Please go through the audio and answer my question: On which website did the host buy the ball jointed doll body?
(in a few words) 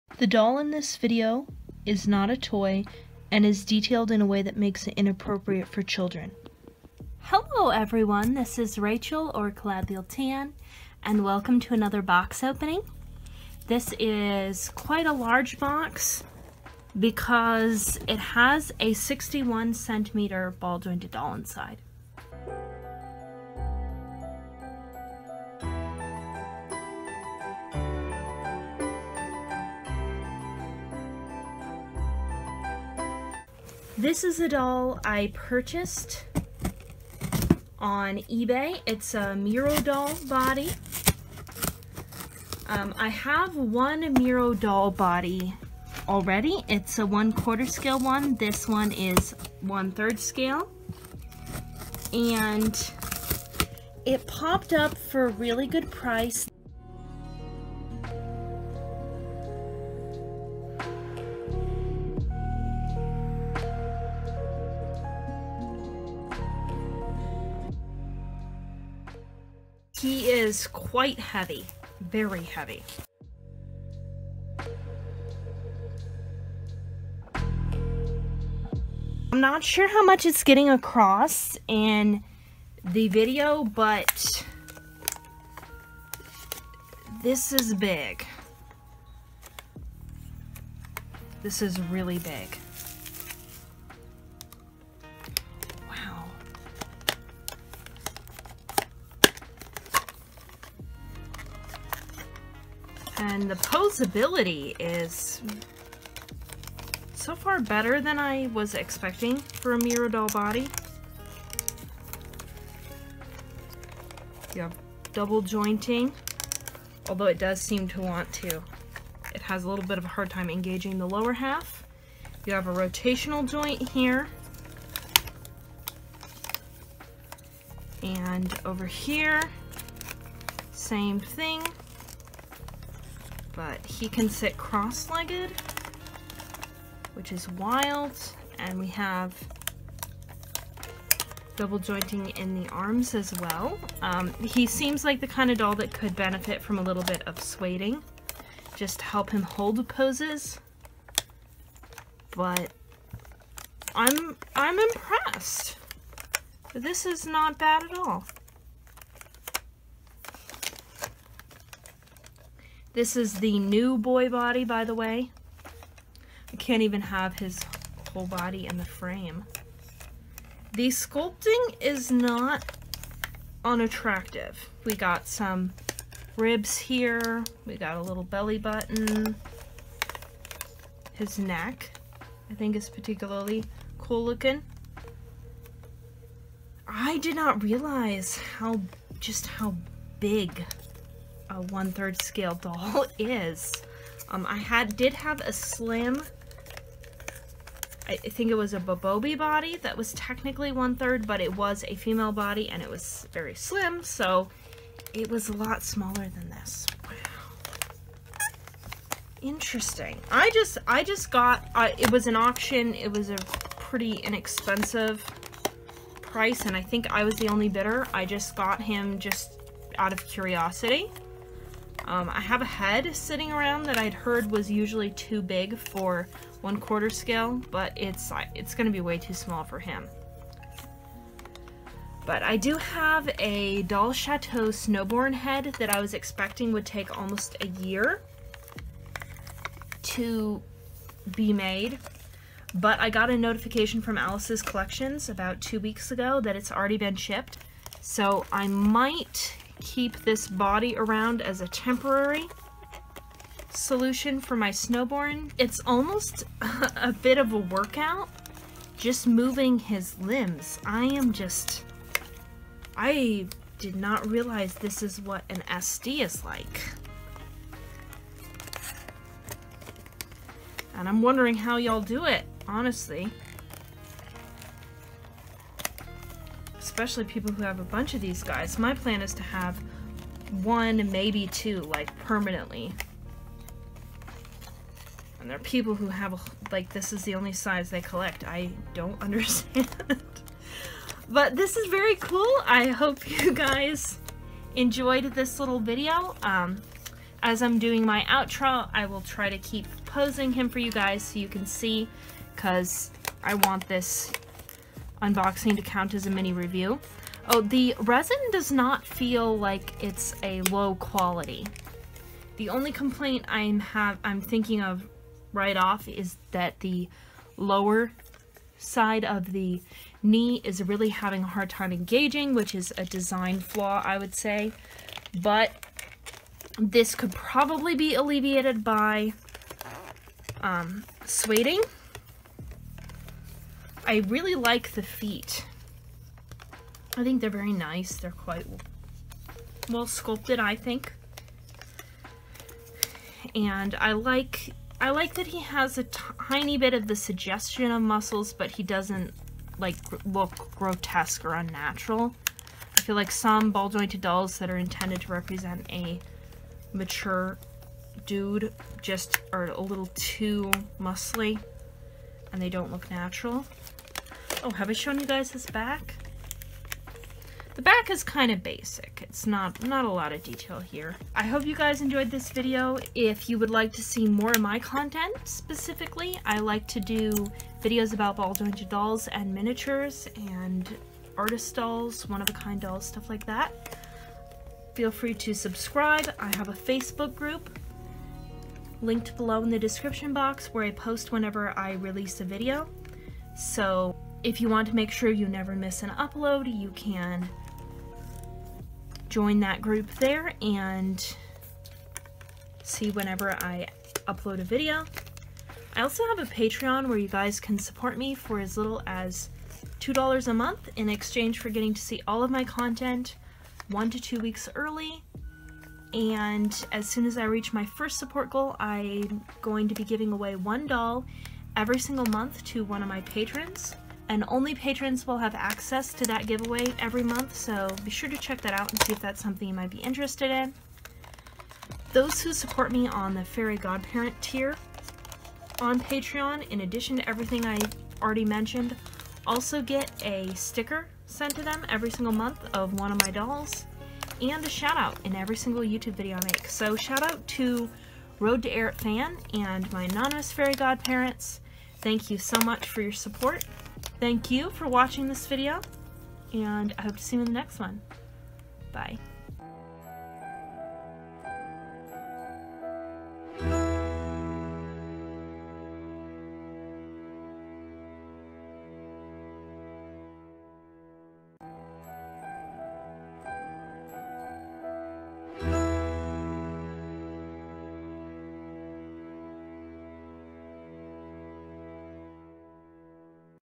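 eBay.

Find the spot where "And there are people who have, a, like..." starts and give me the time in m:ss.
4:45.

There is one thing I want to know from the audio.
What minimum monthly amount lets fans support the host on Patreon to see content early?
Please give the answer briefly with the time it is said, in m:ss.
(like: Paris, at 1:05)
$2, at 6:49.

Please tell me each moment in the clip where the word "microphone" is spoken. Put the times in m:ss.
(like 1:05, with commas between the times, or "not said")
not said.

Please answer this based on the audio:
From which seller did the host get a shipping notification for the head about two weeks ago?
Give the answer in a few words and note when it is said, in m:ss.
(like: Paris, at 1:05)
Alice's Collections, at 4:04.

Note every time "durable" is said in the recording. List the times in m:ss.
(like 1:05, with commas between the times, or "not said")
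not said.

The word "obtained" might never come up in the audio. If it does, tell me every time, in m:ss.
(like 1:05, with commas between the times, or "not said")
not said.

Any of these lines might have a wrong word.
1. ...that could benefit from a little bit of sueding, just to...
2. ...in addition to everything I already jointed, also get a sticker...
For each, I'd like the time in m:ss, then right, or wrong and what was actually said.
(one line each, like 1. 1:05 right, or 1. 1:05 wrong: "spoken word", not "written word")
1. 2:25 right
2. 7:16 wrong: "mentioned", not "jointed".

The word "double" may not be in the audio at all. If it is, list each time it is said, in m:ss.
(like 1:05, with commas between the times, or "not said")
1:55, 2:21.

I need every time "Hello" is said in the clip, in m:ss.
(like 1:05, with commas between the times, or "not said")
0:07.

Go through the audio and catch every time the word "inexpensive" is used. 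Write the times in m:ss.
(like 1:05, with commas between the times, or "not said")
3:34.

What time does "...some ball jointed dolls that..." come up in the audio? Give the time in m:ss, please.
5:53.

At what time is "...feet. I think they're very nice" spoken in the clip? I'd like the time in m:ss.
5:35.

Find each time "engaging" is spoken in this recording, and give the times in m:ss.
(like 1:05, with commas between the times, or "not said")
2:00, 5:21.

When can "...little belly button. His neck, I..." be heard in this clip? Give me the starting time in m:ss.
2:58.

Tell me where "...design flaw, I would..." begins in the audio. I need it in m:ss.
5:23.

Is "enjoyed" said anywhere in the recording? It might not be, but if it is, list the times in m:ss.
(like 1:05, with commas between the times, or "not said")
4:54, 6:11.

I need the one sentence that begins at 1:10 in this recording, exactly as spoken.
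He is quite heavy, very heavy.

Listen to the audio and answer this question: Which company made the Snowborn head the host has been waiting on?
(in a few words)
Doll Chateau.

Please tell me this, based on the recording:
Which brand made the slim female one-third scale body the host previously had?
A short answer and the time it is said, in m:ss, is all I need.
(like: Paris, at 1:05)
Bobobie, at 3:18.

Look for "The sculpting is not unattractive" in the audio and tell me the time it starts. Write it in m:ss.
2:50.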